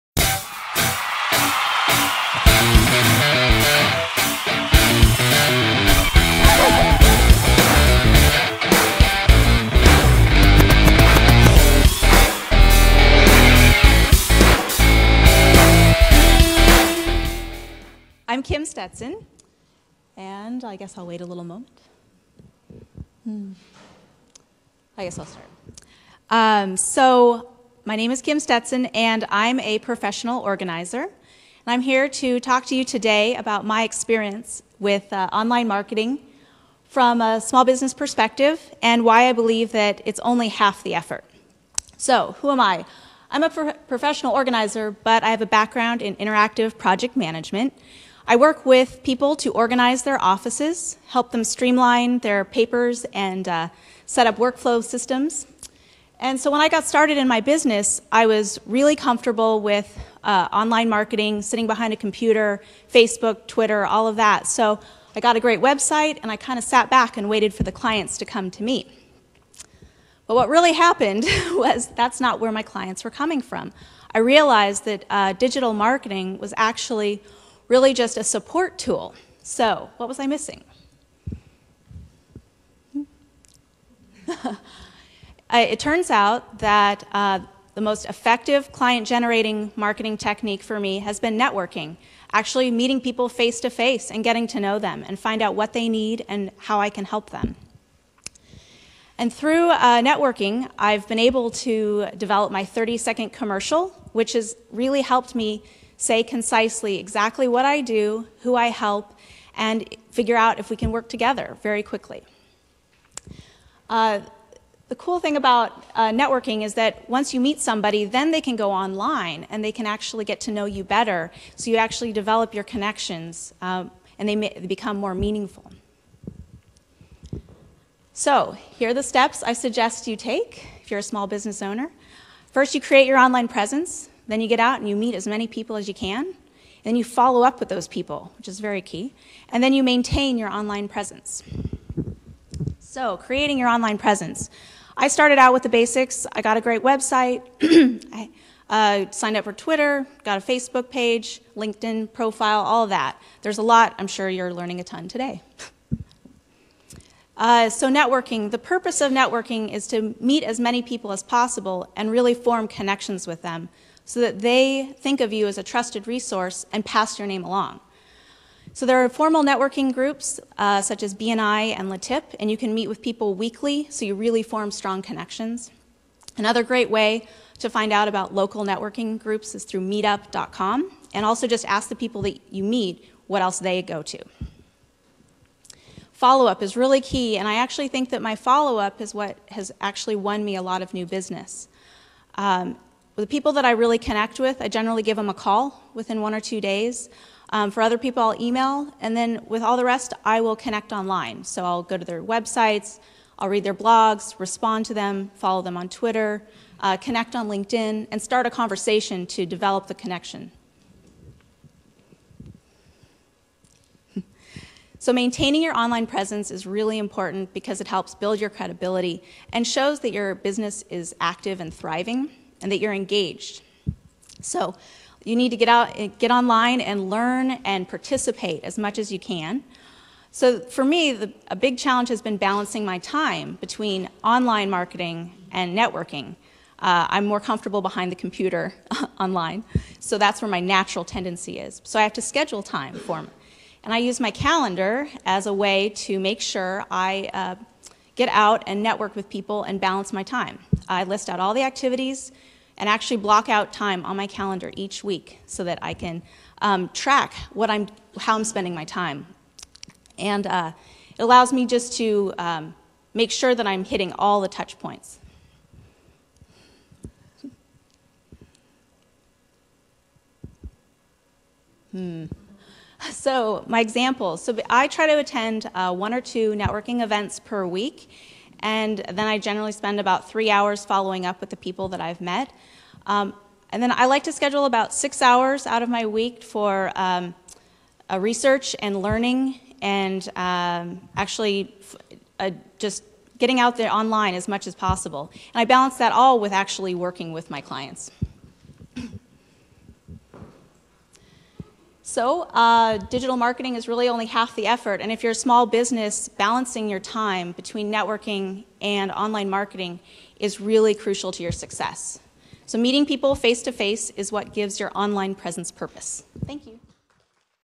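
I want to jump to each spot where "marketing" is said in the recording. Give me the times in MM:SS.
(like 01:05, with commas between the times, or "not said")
00:35, 01:00, 01:15, 01:29, 03:54, 05:03, 05:09.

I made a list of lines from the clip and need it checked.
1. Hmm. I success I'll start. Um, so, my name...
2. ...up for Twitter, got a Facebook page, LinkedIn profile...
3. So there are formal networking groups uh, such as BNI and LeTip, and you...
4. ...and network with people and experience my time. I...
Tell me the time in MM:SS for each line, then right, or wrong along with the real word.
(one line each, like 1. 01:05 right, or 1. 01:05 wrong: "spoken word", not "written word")
1. 00:23 wrong: "guess", not "success"
2. 02:29 right
3. 02:48 right
4. 04:08 wrong: "balance", not "experience".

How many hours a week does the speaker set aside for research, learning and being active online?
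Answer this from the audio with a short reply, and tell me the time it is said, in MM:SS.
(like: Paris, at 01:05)
6 hours, at 04:44.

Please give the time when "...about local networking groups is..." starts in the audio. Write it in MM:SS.
02:58.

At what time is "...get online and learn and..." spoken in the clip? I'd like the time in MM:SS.
03:46.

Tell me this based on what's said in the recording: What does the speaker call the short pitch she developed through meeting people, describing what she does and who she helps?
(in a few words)
30 second commercial.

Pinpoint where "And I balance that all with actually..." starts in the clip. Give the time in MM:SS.
04:55.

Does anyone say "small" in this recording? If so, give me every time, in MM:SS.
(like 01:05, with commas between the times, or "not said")
00:37, 02:11, 05:05.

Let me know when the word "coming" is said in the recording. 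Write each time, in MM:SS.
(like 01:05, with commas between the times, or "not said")
01:13.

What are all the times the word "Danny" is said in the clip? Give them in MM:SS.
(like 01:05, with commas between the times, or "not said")
not said.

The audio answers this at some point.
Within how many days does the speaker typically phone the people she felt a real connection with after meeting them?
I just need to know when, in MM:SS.
03:16.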